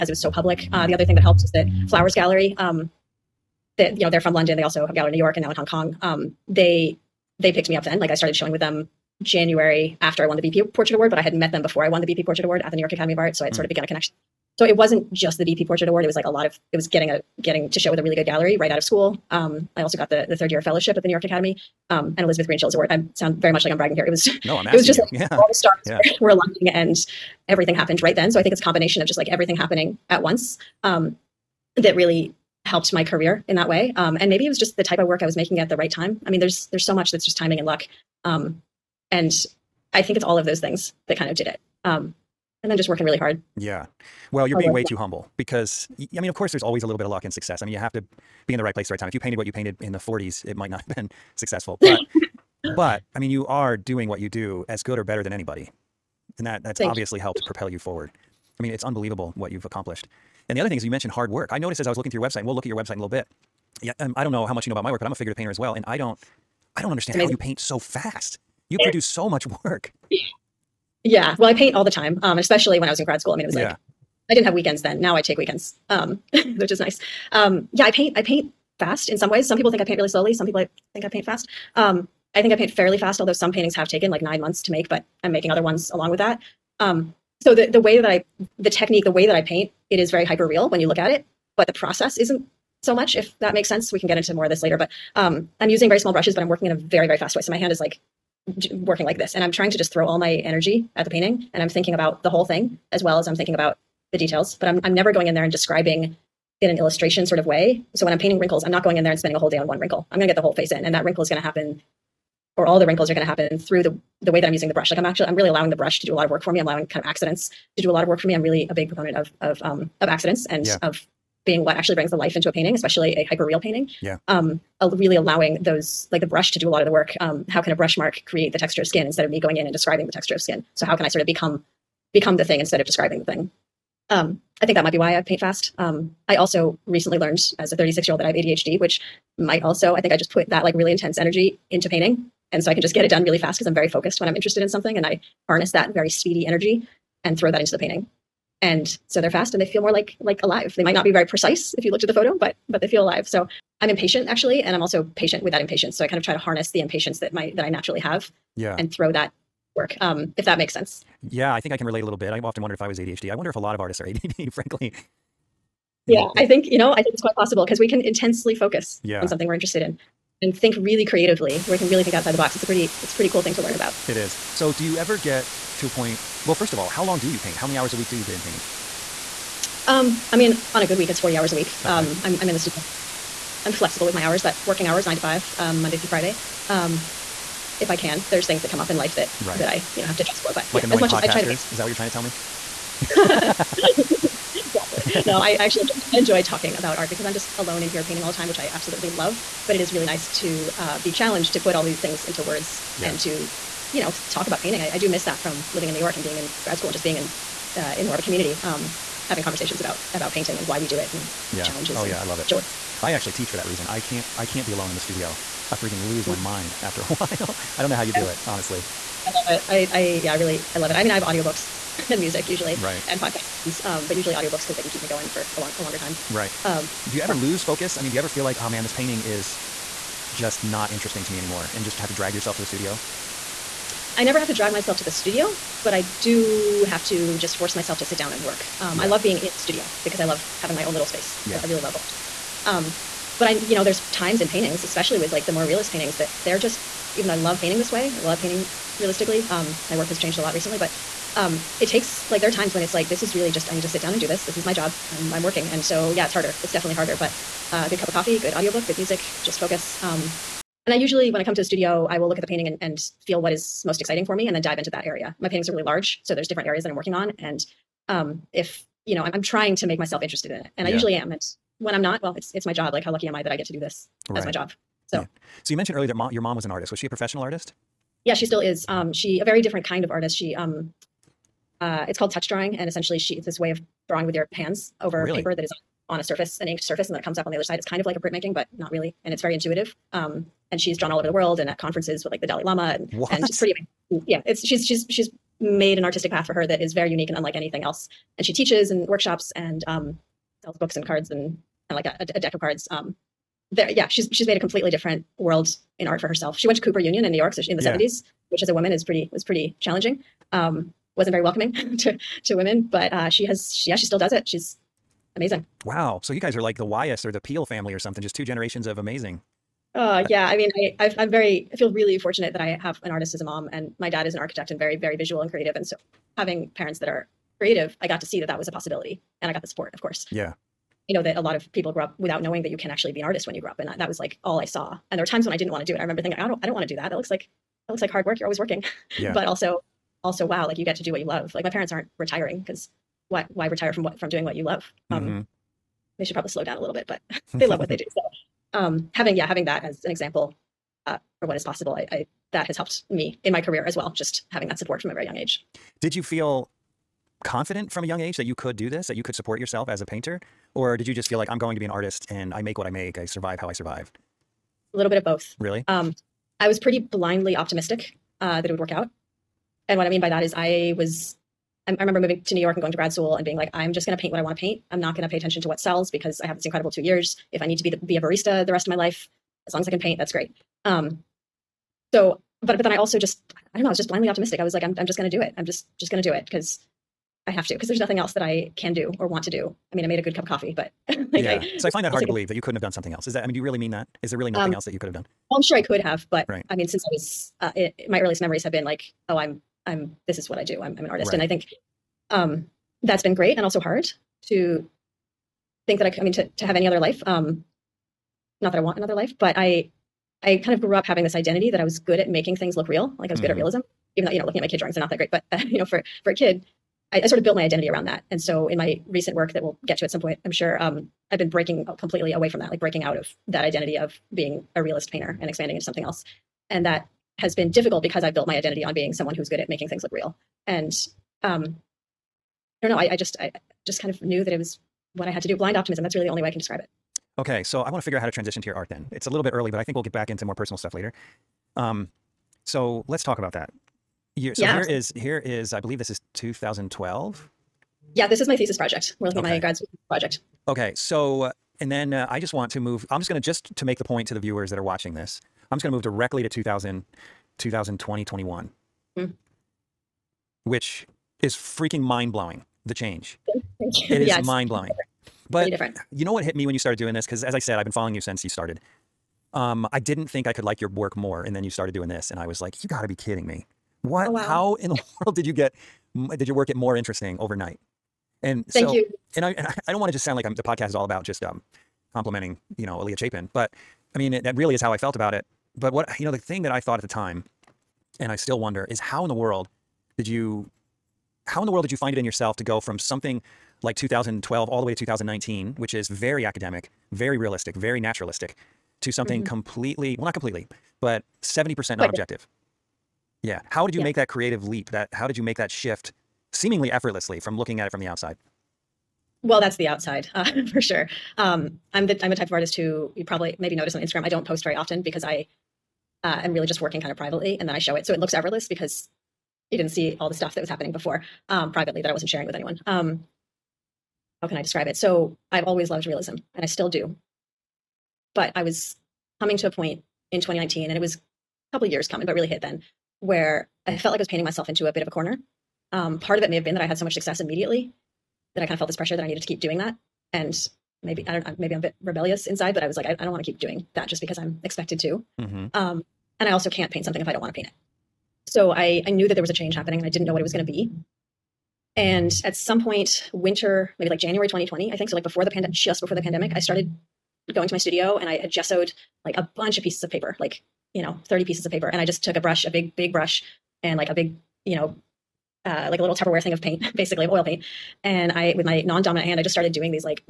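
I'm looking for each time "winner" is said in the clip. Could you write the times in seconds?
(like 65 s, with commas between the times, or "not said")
not said.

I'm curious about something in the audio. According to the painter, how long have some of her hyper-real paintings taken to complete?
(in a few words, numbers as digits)
9 months.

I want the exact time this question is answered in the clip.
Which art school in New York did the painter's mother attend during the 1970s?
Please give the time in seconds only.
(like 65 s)
306 s.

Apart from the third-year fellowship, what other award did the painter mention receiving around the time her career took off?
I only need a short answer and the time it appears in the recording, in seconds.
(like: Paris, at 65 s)
Elizabeth Greenshields award, at 22 s.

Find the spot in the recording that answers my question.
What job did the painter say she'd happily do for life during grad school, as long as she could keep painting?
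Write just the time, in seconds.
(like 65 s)
378 s.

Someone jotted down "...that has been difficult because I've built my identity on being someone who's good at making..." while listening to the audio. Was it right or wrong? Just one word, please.
right.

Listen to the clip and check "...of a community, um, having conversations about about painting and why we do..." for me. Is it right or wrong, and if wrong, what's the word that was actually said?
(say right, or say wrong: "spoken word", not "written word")
right.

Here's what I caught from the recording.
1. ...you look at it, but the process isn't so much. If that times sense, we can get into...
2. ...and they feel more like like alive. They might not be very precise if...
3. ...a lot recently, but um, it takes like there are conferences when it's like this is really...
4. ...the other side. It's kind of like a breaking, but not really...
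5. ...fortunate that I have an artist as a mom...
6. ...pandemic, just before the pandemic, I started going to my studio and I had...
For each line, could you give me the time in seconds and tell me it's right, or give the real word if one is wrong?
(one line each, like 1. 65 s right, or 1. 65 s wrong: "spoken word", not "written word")
1. 90 s wrong: "makes", not "times"
2. 149 s right
3. 250 s wrong: "times", not "conferences"
4. 287 s wrong: "printmaking", not "breaking"
5. 322 s right
6. 555 s right.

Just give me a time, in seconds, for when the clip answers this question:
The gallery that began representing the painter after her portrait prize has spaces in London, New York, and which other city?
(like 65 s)
5 s.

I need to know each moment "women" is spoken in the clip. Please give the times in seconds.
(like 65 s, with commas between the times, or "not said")
312 s.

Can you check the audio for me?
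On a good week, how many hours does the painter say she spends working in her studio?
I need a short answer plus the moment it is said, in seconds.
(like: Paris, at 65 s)
40, at 181 s.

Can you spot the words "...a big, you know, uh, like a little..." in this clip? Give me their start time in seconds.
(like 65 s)
564 s.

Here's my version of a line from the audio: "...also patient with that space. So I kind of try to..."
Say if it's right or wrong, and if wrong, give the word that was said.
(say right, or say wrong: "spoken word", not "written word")
wrong: "impatience", not "space".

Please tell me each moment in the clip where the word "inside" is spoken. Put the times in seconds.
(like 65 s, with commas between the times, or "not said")
542 s.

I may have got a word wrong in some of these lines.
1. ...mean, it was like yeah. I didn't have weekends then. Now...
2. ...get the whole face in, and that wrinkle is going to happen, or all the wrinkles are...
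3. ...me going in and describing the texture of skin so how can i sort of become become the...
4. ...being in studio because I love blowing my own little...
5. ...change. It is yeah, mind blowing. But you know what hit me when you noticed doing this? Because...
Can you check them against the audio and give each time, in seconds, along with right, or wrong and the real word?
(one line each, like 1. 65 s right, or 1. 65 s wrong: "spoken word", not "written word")
1. 73 s right
2. 110 s right
3. 129 s right
4. 239 s wrong: "having", not "blowing"
5. 462 s wrong: "started", not "noticed".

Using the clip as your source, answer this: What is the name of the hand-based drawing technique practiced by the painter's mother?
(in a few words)
touch drawing.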